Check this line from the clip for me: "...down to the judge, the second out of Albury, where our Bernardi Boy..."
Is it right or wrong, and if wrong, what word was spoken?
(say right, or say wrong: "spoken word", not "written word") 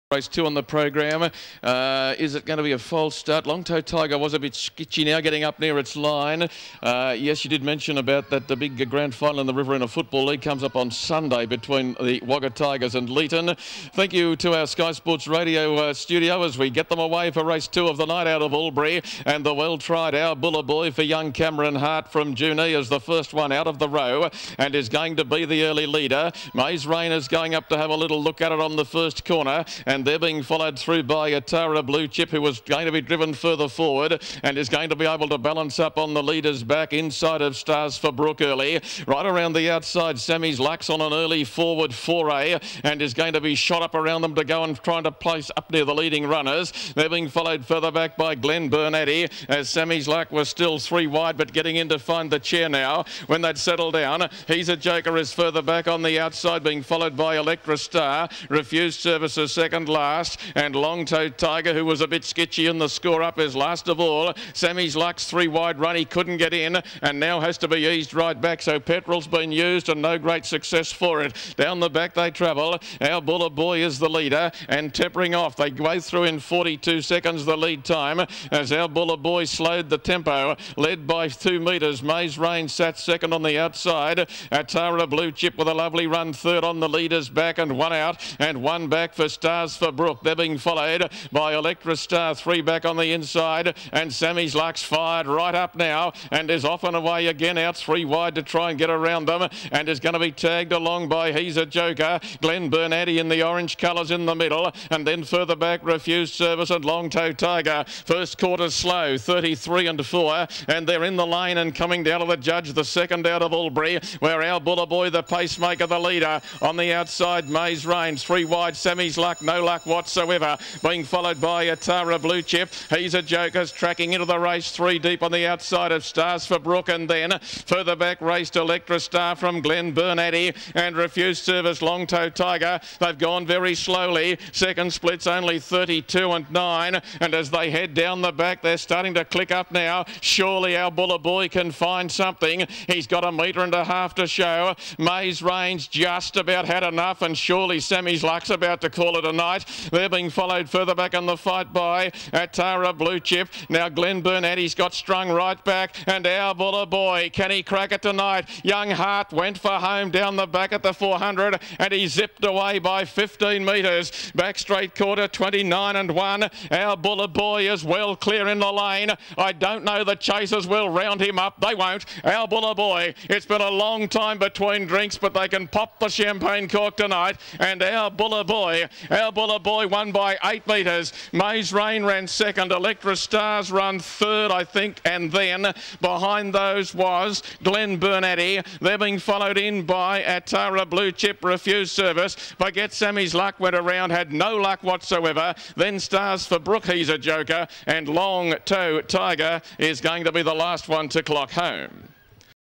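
wrong: "Buller", not "Bernardi".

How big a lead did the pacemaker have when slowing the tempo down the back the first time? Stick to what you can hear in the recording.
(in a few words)
42 seconds.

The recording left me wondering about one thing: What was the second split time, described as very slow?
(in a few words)
32.9.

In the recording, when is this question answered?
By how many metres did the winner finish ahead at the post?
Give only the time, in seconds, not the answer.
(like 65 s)
180 s.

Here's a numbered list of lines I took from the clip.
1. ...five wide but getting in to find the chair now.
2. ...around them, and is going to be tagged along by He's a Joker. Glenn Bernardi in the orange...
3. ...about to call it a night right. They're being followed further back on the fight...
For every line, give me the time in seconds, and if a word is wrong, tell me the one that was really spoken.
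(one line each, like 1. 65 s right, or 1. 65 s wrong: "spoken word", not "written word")
1. 50 s wrong: "three", not "five"
2. 98 s right
3. 148 s right.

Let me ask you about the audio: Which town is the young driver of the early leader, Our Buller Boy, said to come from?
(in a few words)
Junee.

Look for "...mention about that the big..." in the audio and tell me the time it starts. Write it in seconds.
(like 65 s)
7 s.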